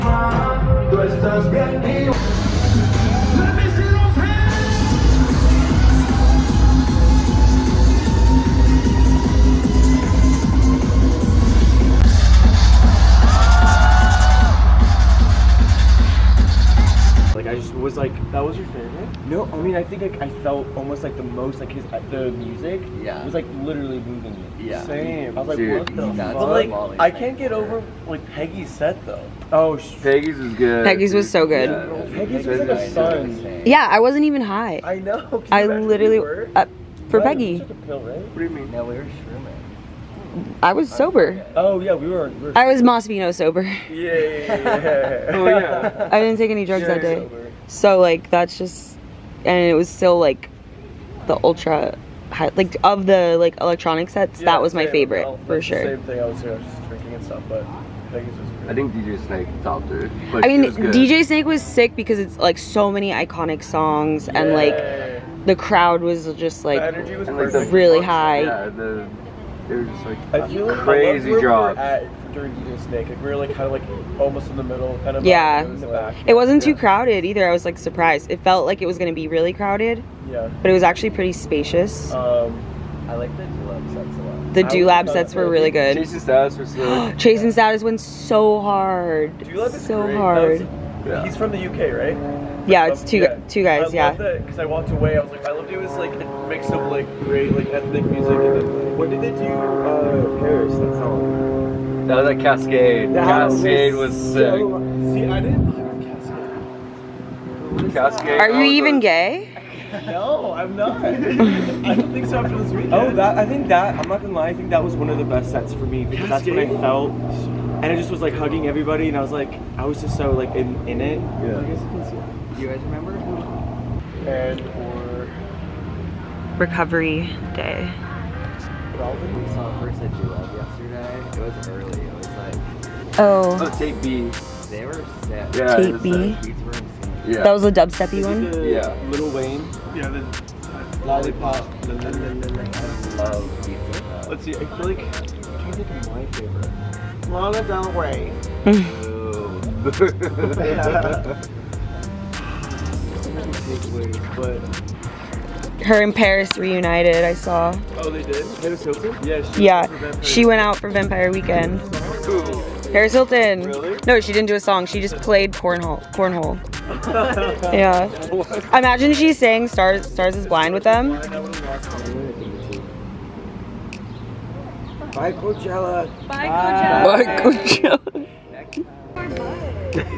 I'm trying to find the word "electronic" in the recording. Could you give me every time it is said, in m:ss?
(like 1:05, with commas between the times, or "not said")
0:53.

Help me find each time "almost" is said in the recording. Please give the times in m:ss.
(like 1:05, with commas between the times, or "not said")
0:20, 1:14.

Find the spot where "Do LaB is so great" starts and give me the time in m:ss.
1:29.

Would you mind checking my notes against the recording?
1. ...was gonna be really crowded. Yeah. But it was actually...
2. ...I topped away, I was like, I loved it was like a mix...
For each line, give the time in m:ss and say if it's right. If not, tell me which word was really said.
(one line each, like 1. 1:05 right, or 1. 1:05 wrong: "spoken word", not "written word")
1. 1:18 right
2. 1:34 wrong: "walked", not "topped".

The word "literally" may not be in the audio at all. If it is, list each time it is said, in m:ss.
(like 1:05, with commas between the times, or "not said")
0:23, 0:35.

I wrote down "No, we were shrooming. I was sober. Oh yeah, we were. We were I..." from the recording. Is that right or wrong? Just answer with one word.
right.